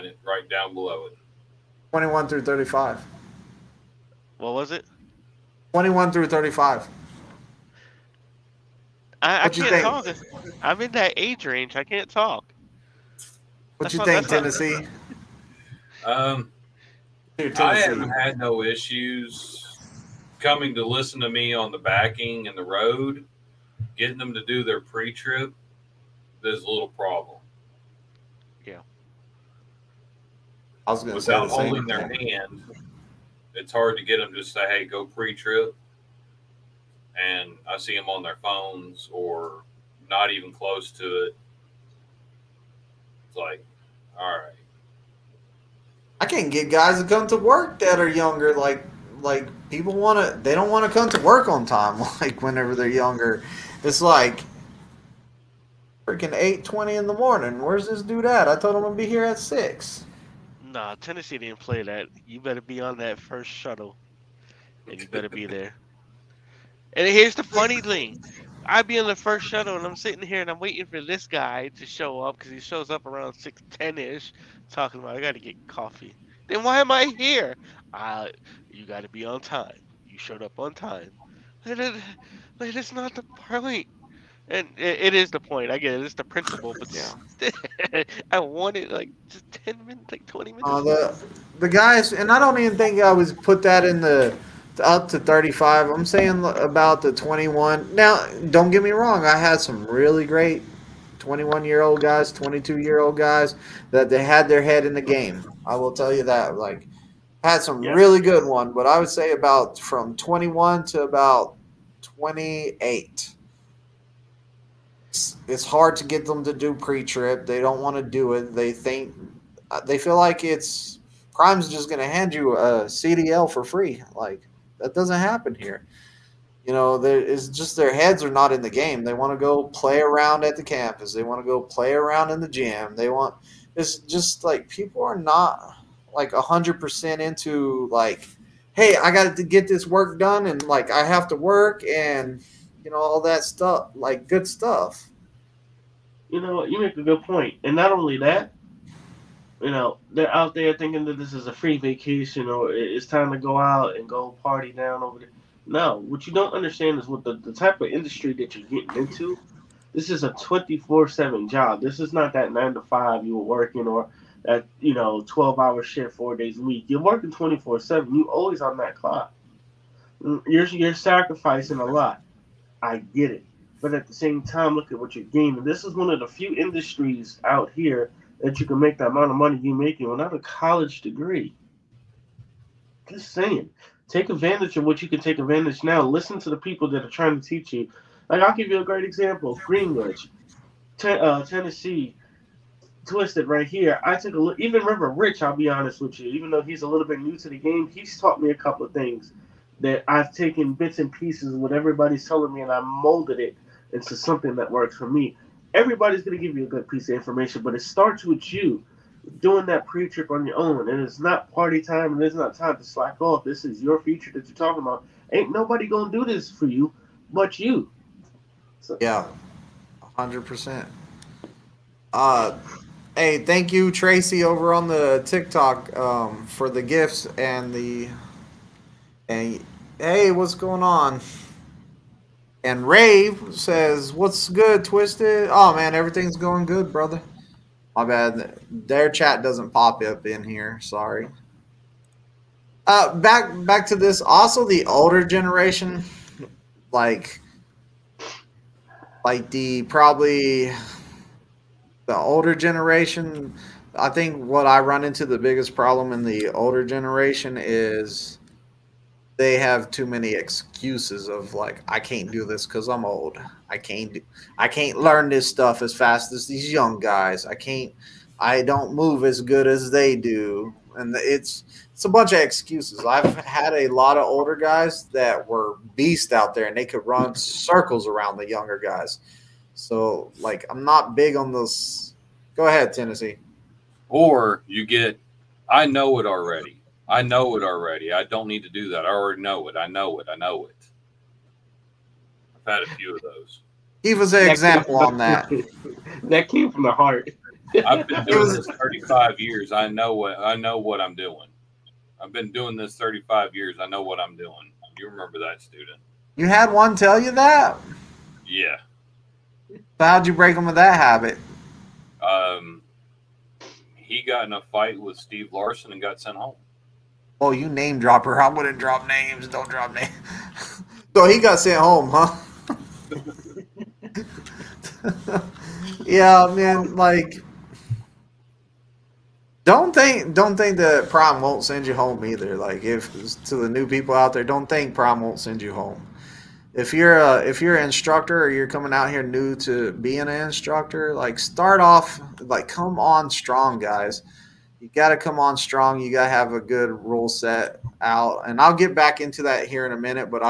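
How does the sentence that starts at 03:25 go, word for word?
Everybody's going to give you a good piece of information, but it starts with you doing that pre trip on your own.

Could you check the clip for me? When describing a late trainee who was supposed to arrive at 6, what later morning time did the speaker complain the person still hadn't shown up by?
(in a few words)
8:20.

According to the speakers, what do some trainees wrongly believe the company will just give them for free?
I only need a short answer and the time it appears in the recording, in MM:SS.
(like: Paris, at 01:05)
A CDL, at 02:02.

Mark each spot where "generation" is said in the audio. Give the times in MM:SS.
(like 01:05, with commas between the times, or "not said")
04:05, 04:12, 04:16.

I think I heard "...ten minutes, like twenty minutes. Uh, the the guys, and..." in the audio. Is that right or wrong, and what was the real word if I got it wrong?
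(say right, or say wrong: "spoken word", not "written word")
right.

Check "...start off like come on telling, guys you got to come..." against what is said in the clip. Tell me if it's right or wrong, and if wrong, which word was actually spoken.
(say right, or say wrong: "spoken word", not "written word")
wrong: "strong", not "telling".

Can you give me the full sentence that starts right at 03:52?
And Rave says, what's good, Twizted?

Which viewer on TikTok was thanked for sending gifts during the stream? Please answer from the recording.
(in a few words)
Tracy.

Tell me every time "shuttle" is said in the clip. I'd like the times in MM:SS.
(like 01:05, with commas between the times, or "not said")
01:03, 01:09.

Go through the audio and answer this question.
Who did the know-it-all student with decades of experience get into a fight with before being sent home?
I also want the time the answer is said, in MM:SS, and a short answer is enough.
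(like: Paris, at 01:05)
Steve Larson, at 05:15.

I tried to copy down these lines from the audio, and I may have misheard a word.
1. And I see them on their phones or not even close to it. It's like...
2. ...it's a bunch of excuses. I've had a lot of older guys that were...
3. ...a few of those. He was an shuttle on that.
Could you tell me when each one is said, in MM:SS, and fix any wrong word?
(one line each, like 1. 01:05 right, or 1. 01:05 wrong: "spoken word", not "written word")
1. 00:37 right
2. 04:31 right
3. 04:52 wrong: "example", not "shuttle".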